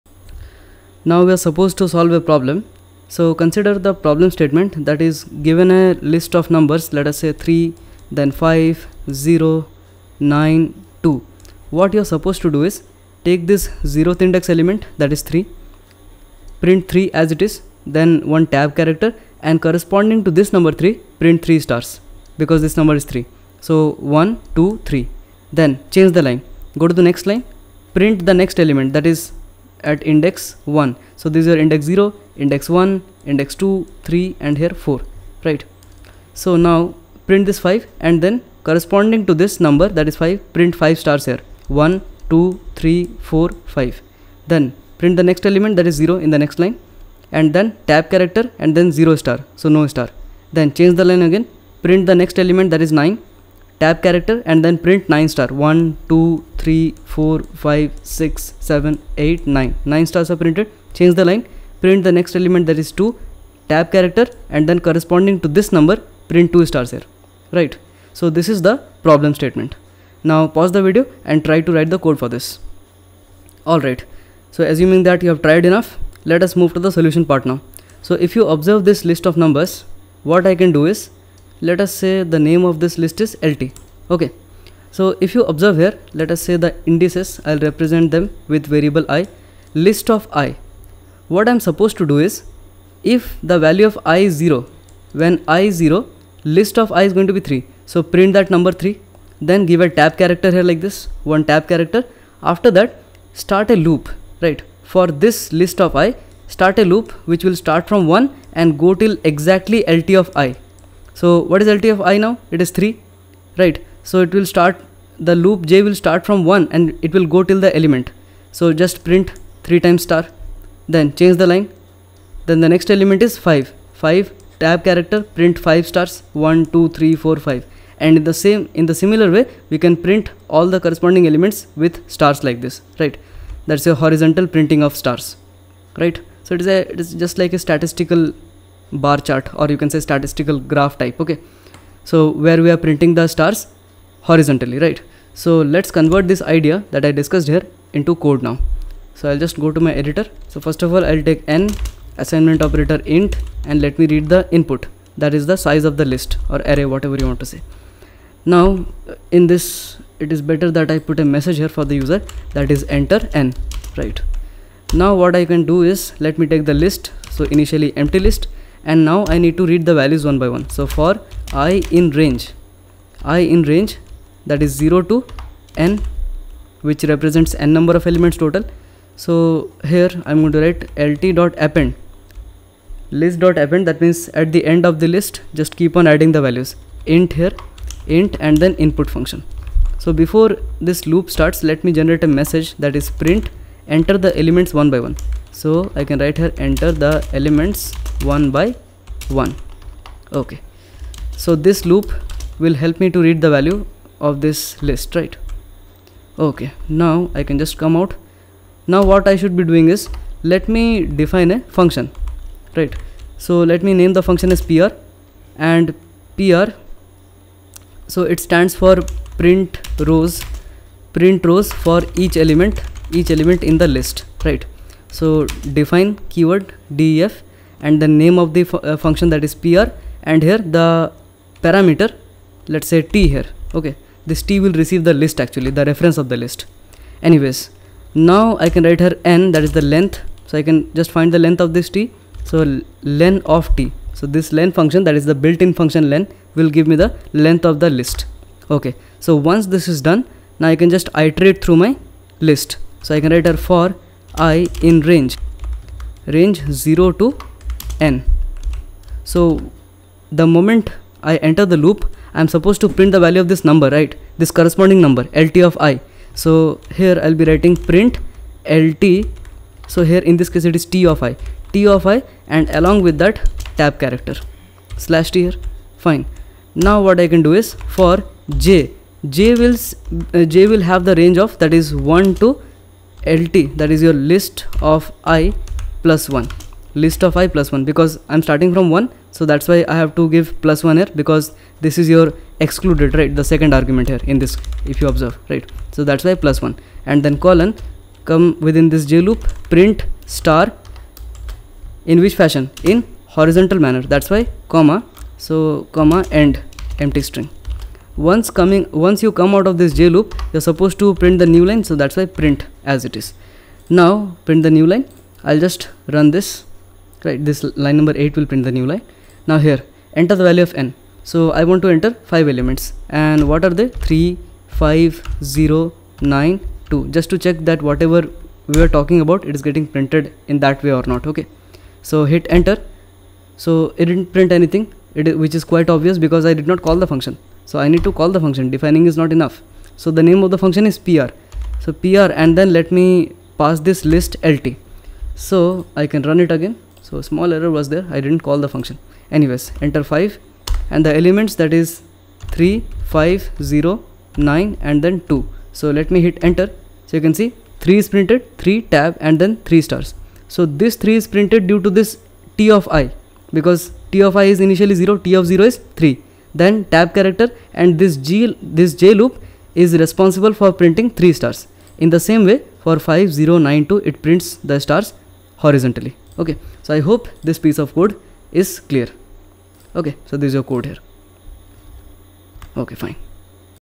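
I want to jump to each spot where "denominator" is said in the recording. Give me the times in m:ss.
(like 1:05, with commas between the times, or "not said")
not said.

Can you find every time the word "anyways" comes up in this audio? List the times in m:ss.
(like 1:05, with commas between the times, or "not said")
3:57, 5:49.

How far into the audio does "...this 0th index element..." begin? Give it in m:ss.
0:13.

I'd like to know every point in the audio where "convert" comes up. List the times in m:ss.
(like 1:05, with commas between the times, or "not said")
2:25.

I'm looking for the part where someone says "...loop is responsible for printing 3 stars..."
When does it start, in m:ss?
6:09.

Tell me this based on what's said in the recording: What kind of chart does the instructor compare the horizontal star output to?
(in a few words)
statistical bar chart.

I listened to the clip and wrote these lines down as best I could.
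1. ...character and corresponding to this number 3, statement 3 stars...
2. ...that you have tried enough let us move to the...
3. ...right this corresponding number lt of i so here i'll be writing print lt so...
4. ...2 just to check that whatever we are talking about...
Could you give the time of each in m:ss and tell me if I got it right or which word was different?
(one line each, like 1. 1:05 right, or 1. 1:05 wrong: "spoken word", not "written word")
1. 0:18 wrong: "print", not "statement"
2. 1:15 right
3. 4:23 right
4. 5:26 right.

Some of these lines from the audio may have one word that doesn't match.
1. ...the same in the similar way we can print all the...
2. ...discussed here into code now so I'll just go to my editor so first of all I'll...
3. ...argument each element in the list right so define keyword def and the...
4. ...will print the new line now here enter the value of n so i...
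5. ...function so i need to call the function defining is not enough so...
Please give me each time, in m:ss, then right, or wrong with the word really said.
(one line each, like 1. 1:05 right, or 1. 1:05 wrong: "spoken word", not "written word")
1. 2:08 right
2. 2:27 right
3. 3:42 wrong: "element", not "argument"
4. 5:18 right
5. 5:37 right.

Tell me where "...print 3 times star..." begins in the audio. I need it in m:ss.
1:59.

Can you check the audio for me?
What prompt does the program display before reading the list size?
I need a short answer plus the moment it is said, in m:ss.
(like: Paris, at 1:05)
enter n, at 2:42.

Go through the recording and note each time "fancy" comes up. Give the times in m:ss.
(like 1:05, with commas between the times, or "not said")
not said.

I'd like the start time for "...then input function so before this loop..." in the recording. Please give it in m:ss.
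3:08.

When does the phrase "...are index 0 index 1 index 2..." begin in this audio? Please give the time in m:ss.
0:31.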